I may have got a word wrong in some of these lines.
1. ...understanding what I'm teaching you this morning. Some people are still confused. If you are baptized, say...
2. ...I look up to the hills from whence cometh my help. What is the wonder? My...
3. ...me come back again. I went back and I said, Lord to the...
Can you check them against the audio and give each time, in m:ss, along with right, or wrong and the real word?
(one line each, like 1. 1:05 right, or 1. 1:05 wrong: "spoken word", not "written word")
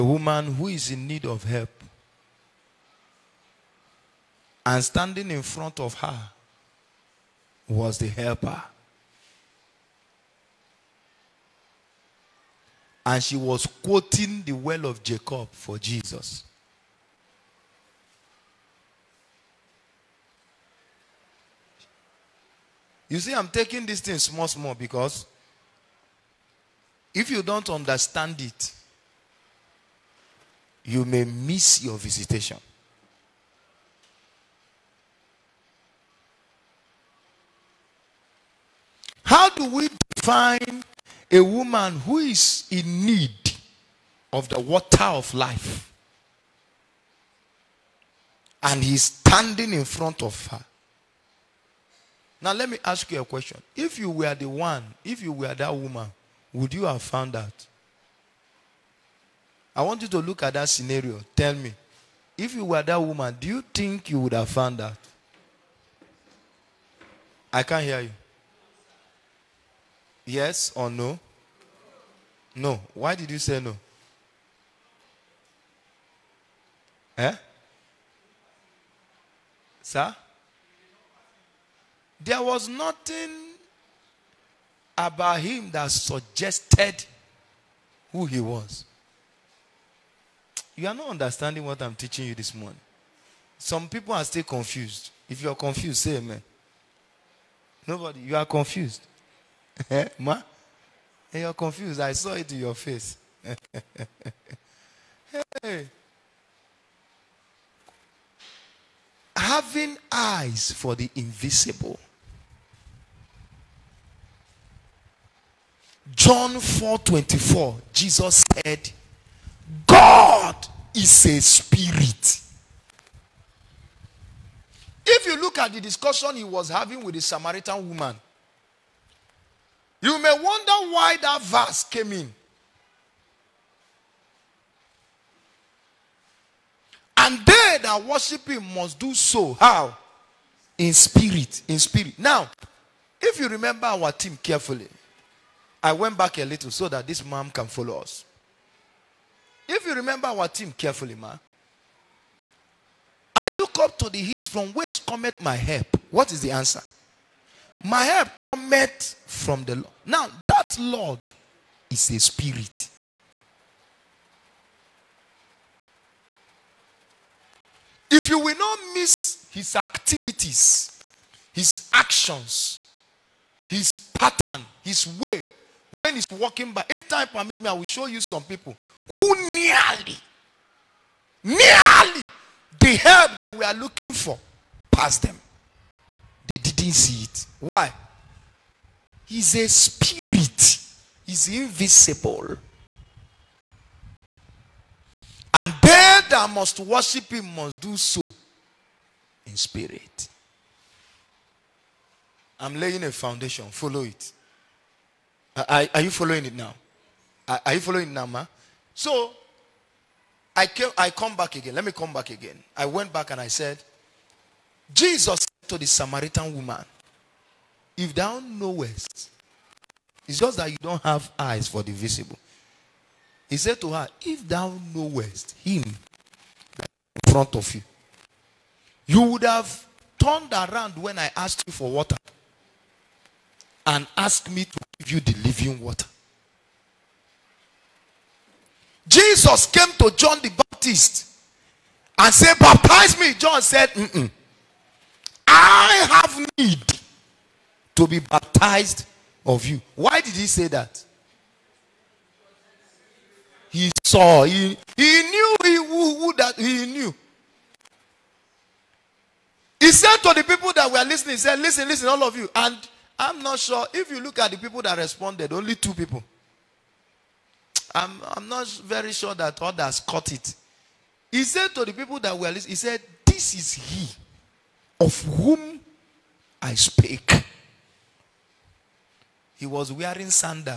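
1. 1:31 wrong: "confused", not "baptized"
2. 2:33 wrong: "answer", not "wonder"
3. 3:31 wrong: "Jesus", not "Lord".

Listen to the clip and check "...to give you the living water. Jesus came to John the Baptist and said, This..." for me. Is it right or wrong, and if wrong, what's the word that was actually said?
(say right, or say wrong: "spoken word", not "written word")
wrong: "Baptize", not "This".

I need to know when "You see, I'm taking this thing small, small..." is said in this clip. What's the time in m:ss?
0:23.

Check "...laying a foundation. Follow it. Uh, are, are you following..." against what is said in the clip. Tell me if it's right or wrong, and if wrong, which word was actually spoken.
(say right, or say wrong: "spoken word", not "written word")
right.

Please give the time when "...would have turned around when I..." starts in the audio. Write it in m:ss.
3:49.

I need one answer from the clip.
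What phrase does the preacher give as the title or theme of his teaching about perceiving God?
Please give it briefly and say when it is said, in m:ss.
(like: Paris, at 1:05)
Having eyes for the invisible, at 1:49.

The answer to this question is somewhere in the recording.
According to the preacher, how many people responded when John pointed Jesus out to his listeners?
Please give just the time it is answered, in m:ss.
4:25.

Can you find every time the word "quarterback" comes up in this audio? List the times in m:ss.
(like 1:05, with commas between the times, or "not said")
not said.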